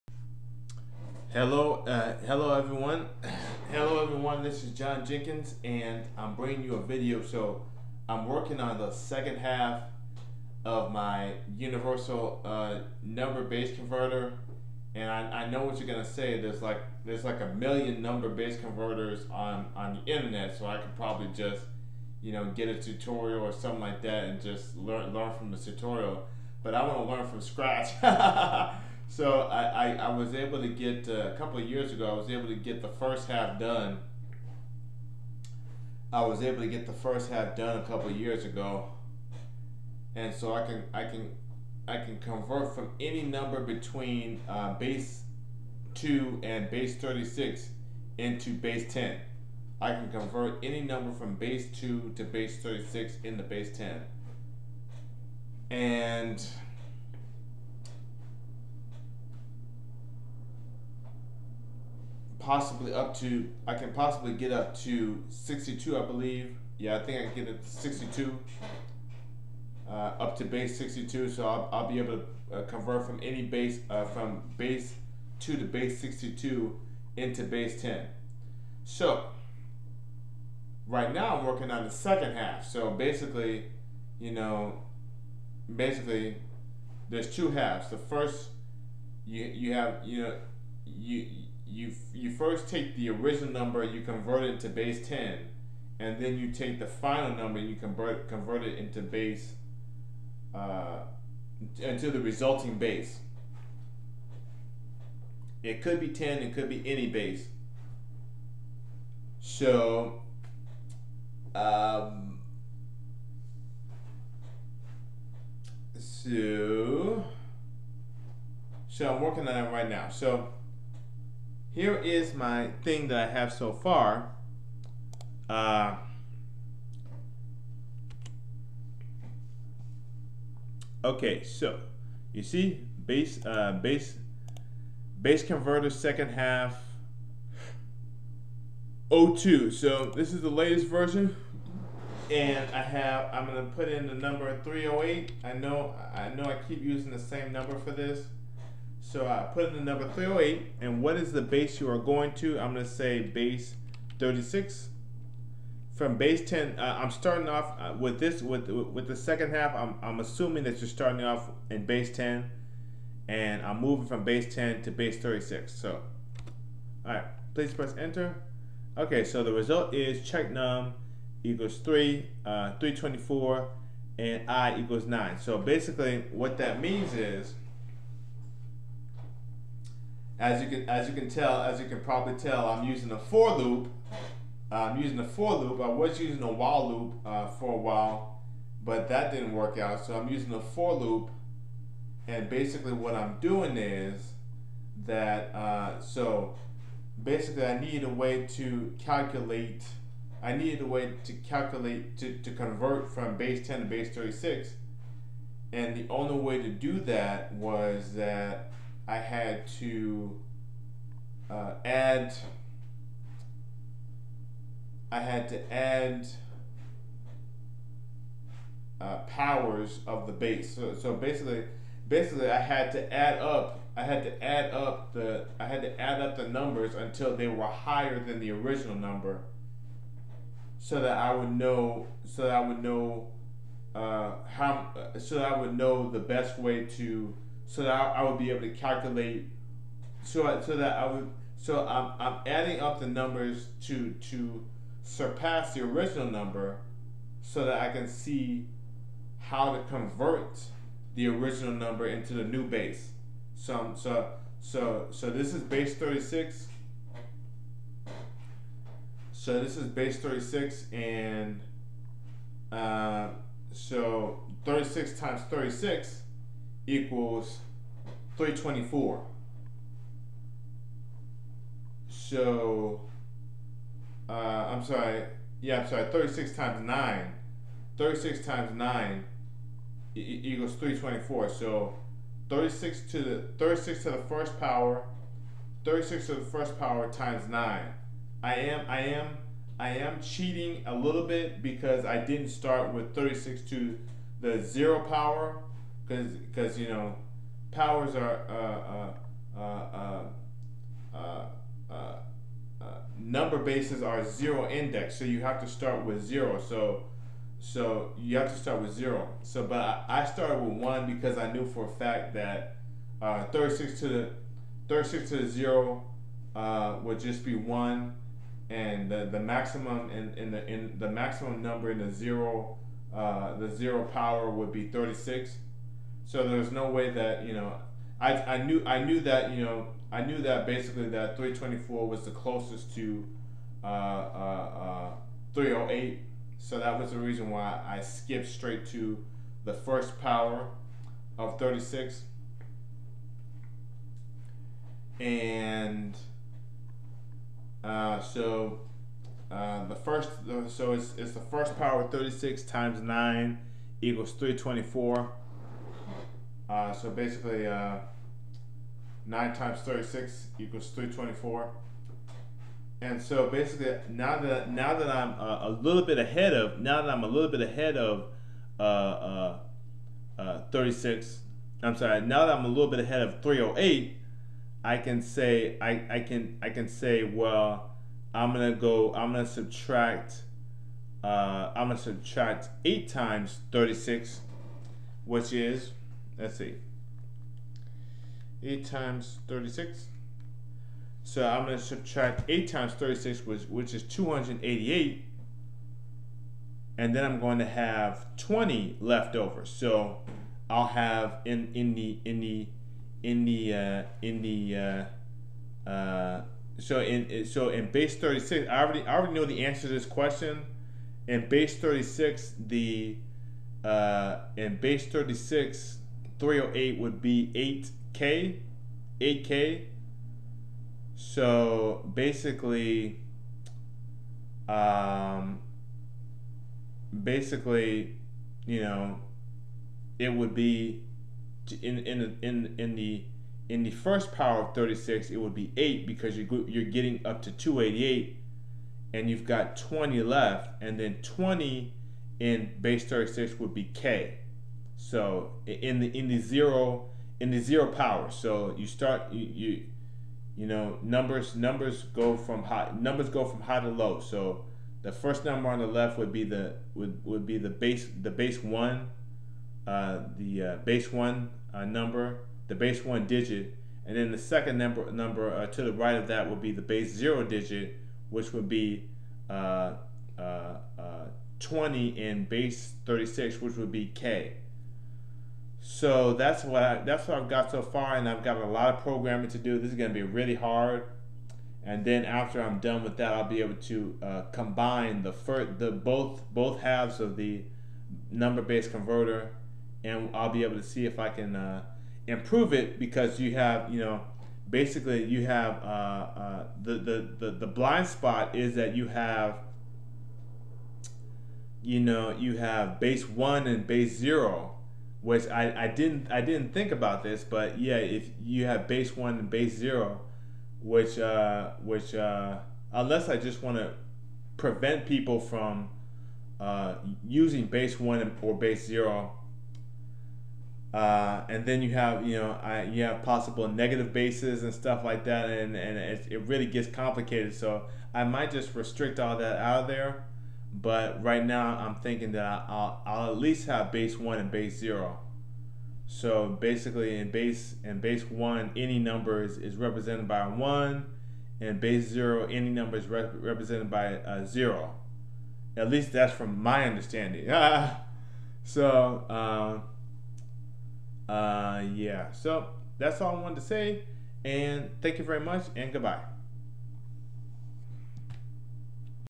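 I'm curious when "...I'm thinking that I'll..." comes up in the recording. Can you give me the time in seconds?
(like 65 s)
531 s.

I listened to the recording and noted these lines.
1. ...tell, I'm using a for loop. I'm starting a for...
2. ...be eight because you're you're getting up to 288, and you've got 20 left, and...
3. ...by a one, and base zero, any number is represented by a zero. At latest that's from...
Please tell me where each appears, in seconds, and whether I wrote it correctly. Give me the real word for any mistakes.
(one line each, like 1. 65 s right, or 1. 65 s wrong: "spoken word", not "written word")
1. 182 s wrong: "using", not "starting"
2. 435 s right
3. 540 s wrong: "least", not "latest".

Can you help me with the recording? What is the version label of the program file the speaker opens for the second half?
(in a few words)
02.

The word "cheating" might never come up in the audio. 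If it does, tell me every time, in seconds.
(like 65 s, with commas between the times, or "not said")
290 s.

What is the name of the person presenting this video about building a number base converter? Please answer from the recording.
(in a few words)
John Jenkins.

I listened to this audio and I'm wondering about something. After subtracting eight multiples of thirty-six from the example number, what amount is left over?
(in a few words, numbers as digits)
20.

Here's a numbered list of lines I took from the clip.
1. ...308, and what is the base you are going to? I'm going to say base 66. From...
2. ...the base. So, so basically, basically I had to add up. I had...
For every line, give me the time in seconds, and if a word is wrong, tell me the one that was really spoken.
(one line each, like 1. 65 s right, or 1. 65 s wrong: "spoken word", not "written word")
1. 150 s wrong: "36", not "66"
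2. 220 s right.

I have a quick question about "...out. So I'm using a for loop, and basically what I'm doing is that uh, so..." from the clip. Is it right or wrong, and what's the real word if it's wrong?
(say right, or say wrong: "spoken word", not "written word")
right.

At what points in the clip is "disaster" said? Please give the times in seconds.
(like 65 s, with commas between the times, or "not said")
not said.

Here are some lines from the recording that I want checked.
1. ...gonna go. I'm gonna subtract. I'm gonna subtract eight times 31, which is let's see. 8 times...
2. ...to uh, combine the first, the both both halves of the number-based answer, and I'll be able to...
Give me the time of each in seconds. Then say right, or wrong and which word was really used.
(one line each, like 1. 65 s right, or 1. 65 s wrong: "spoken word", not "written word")
1. 378 s wrong: "36", not "31"
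2. 483 s wrong: "converter", not "answer".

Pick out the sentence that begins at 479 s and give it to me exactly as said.
This is going to be really hard.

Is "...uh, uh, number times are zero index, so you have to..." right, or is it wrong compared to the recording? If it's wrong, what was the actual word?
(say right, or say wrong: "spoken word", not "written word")
wrong: "bases", not "times".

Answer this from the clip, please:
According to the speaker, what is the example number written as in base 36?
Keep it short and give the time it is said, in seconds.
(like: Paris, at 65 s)
8K, at 418 s.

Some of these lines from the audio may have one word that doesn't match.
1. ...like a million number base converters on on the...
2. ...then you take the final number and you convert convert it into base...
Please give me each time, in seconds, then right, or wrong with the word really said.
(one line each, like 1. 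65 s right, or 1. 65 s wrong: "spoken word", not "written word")
1. 17 s right
2. 96 s right.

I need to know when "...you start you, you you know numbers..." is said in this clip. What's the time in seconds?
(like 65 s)
448 s.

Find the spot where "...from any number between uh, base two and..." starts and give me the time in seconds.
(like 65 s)
42 s.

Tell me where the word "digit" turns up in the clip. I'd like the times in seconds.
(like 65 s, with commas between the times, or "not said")
463 s, 467 s.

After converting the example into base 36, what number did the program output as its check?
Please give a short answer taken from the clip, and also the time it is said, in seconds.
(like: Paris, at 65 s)
324, at 172 s.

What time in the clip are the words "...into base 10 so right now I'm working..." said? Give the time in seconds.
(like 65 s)
77 s.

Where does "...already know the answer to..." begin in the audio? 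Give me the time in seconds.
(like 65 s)
409 s.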